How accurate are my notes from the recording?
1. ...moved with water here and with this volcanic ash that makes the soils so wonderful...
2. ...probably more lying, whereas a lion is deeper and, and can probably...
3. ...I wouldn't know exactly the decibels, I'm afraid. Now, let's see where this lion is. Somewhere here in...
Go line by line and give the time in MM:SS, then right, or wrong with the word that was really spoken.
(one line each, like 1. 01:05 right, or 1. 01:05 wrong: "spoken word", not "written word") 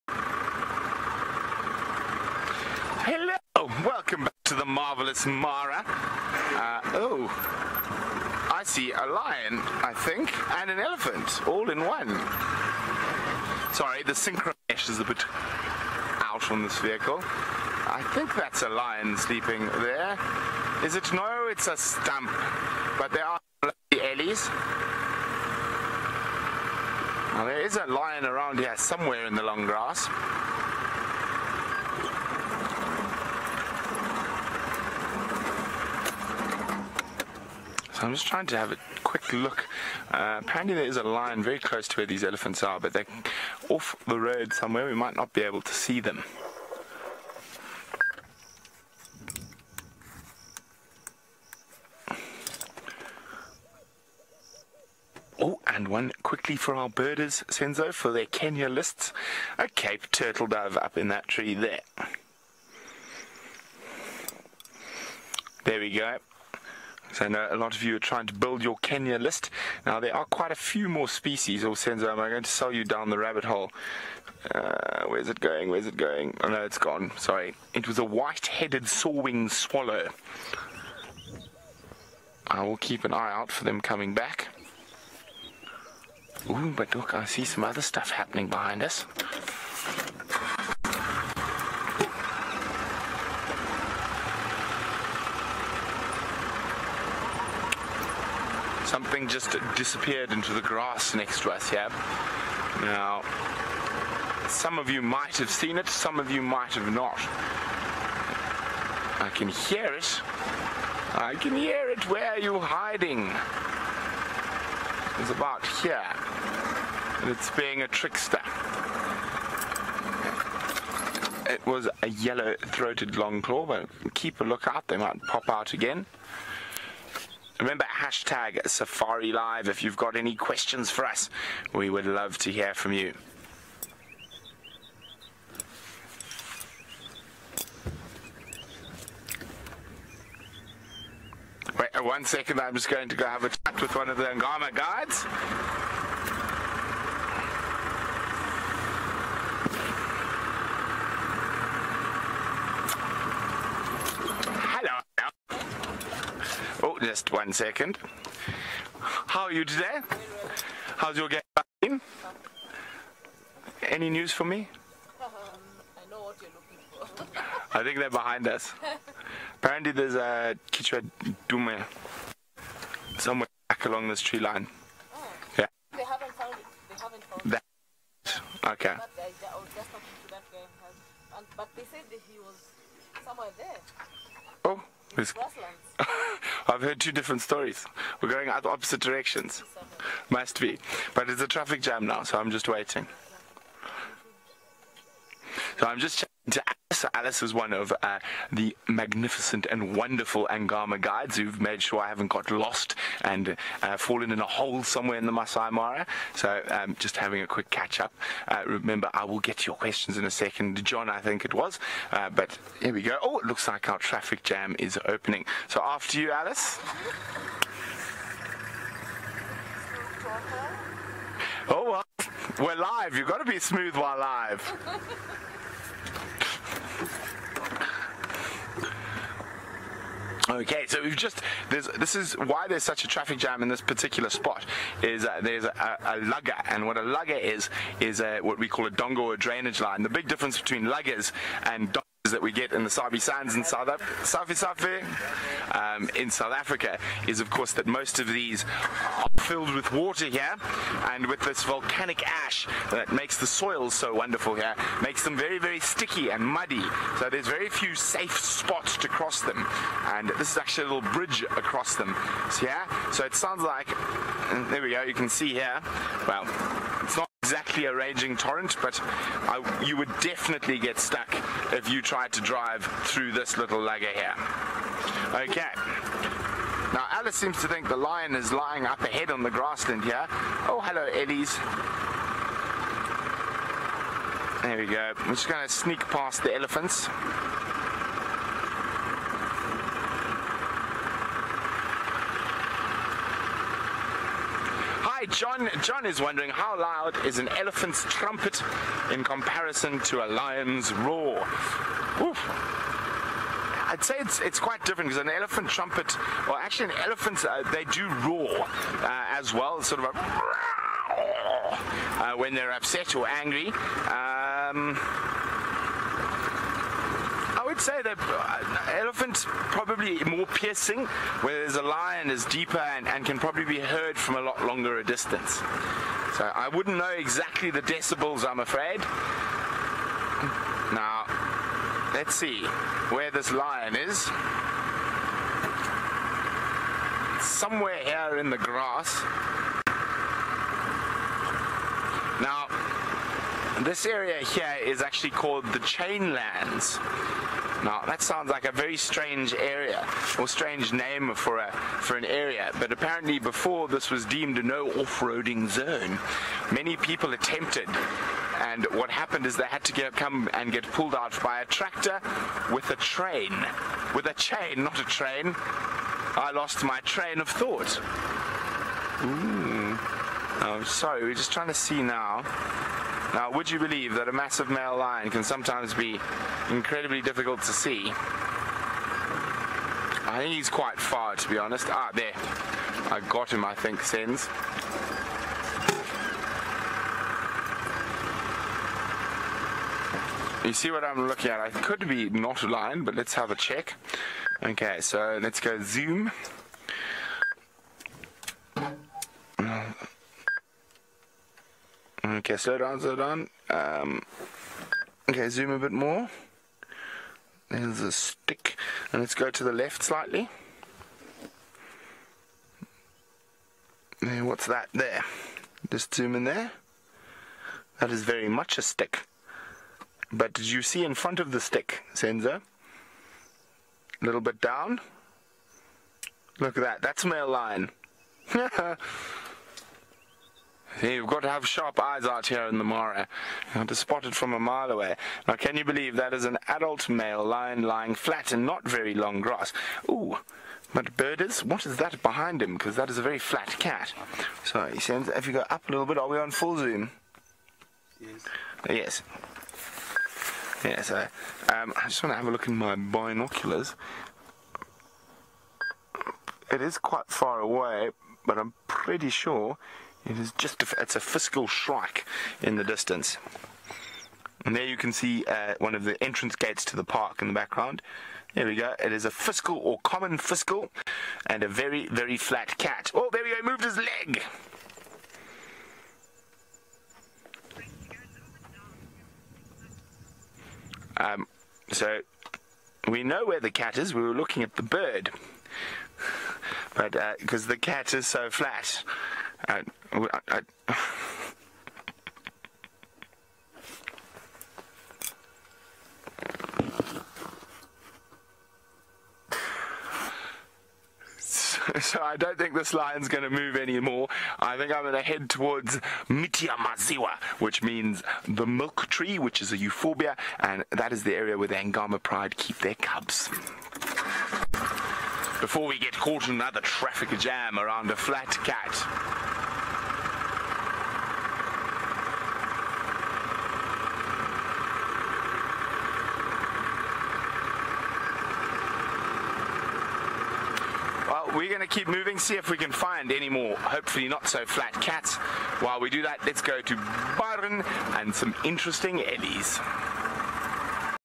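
1. 04:09 wrong: "filled", not "moved"
2. 05:19 wrong: "piercing", not "lying"
3. 05:26 right.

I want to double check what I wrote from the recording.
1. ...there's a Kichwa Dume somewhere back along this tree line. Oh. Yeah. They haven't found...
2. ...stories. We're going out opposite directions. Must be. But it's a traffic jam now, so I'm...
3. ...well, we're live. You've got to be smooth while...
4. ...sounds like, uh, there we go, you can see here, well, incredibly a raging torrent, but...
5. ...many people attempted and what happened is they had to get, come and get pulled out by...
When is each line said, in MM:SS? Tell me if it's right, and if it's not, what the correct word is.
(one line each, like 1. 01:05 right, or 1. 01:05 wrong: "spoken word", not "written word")
1. 02:49 right
2. 03:07 right
3. 03:41 right
4. 04:23 wrong: "exactly", not "incredibly"
5. 05:56 right.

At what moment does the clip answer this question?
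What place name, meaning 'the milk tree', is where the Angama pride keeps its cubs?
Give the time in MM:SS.
08:26.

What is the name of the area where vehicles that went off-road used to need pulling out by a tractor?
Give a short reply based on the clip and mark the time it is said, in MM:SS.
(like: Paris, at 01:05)
Chainlands, at 05:45.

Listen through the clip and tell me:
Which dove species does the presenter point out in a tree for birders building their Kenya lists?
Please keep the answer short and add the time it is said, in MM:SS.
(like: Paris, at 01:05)
Cape turtle dove, at 00:59.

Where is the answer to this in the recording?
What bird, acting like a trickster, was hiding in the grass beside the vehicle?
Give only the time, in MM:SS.
02:02.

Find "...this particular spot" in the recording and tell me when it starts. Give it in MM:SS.
03:53.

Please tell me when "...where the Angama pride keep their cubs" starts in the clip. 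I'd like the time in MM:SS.
08:31.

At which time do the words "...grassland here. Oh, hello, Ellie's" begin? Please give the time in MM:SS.
04:39.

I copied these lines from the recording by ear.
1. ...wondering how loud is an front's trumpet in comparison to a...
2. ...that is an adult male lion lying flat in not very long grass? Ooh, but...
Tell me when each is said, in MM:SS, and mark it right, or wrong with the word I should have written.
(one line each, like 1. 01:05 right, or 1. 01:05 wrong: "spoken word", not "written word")
1. 04:56 wrong: "elephant", not "front"
2. 07:16 right.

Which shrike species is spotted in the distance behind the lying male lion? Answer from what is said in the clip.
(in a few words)
Fiscal shrike.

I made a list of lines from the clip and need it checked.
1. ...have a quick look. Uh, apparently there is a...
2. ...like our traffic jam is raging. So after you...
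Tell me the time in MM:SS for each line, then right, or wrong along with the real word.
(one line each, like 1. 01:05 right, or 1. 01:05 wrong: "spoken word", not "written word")
1. 00:38 right
2. 03:33 wrong: "opening", not "raging".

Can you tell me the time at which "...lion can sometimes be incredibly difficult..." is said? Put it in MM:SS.
06:14.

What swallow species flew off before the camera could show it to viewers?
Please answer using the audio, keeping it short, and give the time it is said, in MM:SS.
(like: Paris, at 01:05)
White-headed sawwing swallow, at 01:18.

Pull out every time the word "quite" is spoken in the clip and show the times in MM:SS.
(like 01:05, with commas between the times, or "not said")
01:10, 05:04, 06:20, 07:36.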